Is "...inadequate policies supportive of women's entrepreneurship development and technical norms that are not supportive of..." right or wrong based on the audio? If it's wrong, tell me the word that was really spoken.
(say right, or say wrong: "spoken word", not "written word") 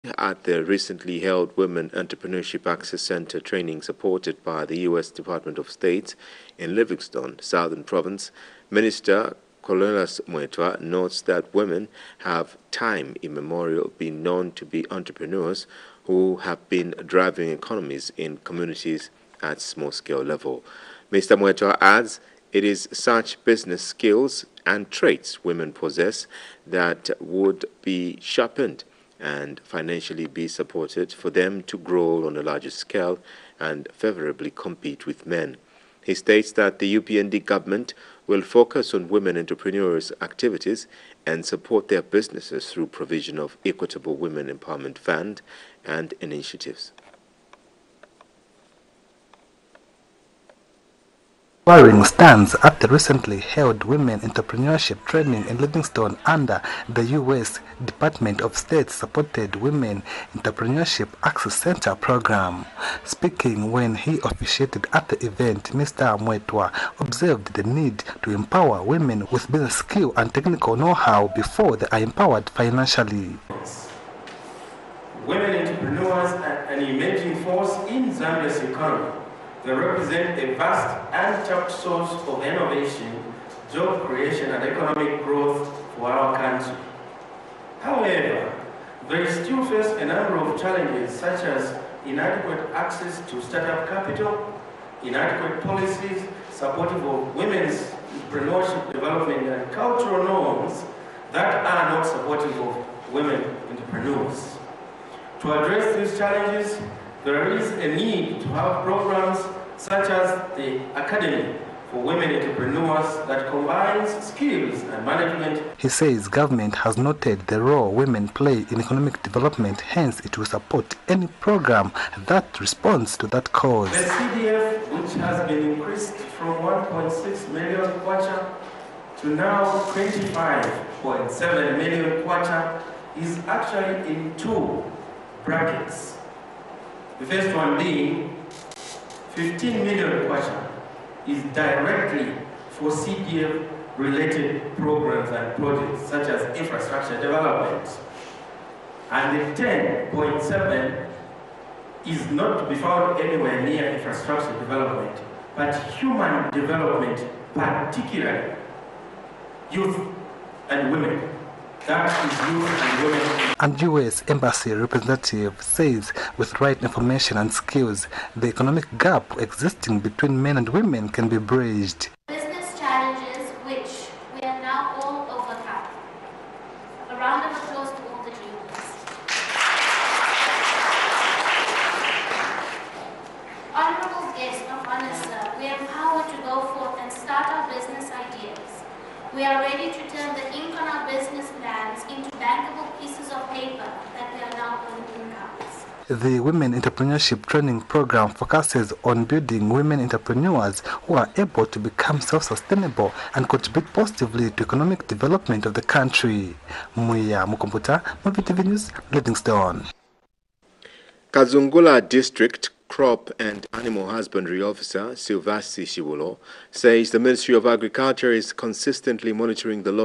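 wrong: "cultural", not "technical".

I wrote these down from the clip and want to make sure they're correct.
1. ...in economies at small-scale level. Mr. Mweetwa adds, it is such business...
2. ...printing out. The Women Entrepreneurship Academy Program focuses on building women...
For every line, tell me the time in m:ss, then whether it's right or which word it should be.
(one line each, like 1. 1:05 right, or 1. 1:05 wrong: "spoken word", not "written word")
1. 0:18 wrong: "communities", not "economies"
2. 3:14 wrong: "Training", not "Academy".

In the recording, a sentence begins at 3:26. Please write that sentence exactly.
Muya Mukomputa, Muvi TV News, Livingstone.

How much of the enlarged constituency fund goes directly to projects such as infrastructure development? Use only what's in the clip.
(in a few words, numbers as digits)
15 million kwacha.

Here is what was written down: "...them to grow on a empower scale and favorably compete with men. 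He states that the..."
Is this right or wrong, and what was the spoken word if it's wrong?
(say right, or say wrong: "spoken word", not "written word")
wrong: "larger", not "empower".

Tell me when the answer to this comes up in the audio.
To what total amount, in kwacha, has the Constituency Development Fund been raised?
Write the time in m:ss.
2:09.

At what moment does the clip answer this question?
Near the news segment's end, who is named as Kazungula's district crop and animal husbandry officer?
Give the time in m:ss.
3:35.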